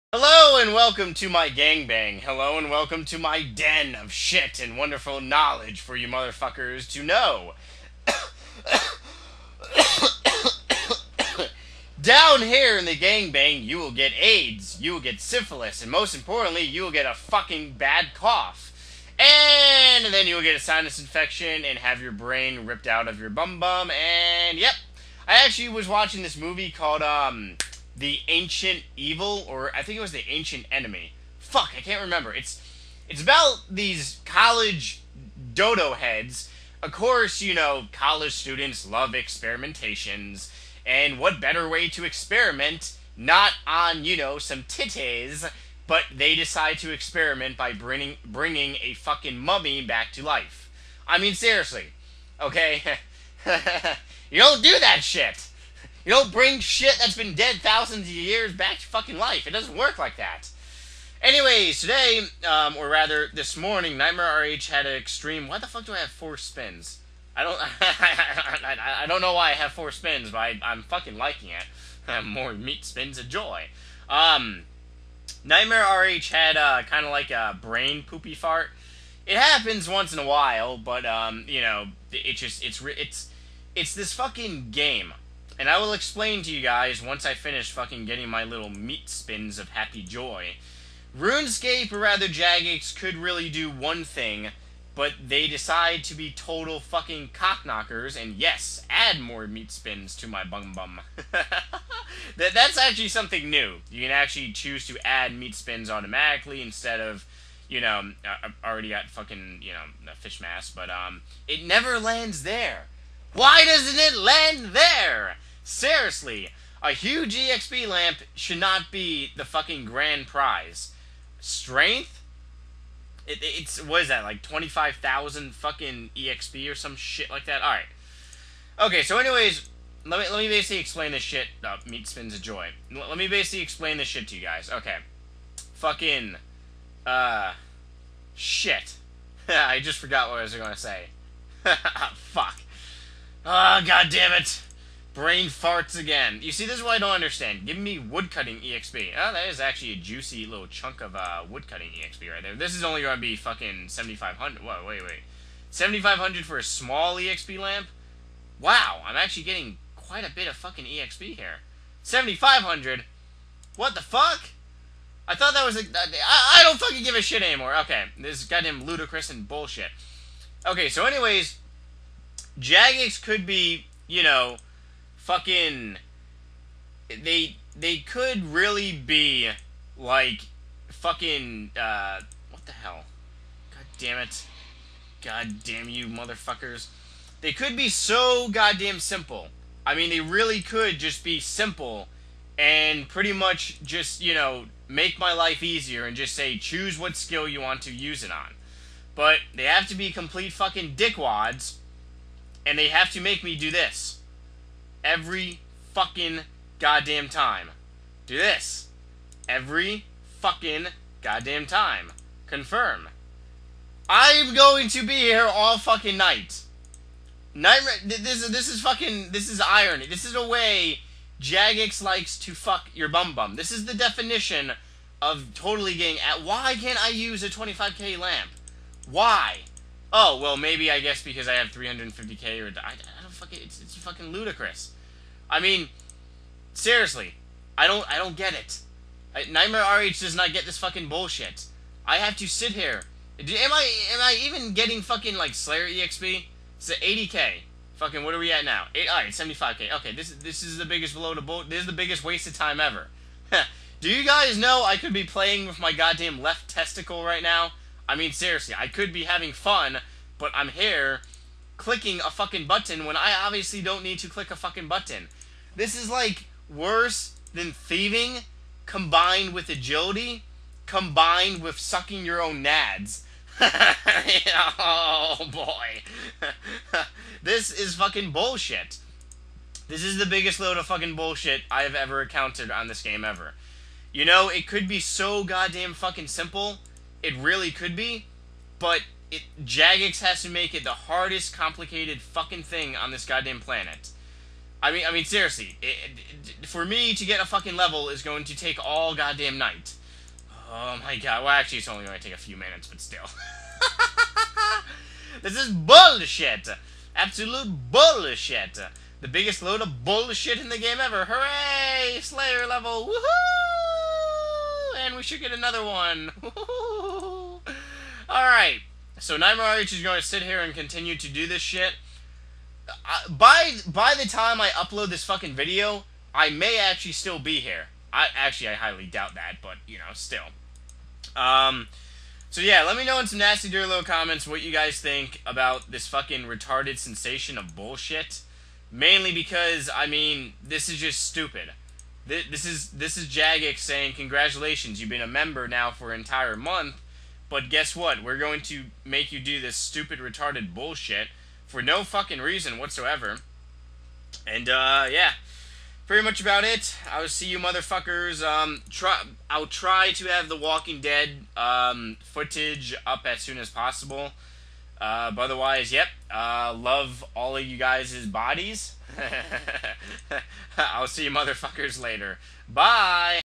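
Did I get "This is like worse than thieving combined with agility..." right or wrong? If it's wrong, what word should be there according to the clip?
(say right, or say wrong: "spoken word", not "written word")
right.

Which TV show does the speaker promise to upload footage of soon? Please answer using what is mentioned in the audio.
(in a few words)
The Walking Dead.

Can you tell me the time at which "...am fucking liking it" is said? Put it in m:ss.
1:10.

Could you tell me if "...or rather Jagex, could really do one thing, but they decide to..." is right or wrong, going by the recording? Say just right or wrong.
right.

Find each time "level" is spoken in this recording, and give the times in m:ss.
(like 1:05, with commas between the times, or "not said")
4:57, 5:12.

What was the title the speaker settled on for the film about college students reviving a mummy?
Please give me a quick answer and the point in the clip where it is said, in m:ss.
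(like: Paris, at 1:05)
The Ancient Enemy, at 0:30.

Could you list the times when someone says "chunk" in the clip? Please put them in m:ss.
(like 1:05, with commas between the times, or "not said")
2:30.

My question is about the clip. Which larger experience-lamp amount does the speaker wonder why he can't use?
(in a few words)
25k.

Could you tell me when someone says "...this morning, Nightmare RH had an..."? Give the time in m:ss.
1:03.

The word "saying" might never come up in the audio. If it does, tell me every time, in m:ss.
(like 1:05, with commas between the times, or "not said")
5:43.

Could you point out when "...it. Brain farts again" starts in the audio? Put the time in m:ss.
2:24.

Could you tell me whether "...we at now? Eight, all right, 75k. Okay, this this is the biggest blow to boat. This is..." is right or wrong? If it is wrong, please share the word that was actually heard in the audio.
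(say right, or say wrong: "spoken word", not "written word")
right.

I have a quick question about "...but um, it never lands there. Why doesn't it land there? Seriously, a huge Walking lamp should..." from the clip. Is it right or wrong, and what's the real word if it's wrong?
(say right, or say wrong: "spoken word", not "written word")
wrong: "EXP", not "Walking".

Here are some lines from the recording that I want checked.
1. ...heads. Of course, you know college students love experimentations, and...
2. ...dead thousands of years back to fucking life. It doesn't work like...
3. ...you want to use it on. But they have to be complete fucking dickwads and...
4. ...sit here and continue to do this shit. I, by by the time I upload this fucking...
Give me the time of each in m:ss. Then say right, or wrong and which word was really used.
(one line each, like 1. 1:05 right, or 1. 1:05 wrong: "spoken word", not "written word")
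1. 0:35 right
2. 0:57 right
3. 3:17 right
4. 5:20 right.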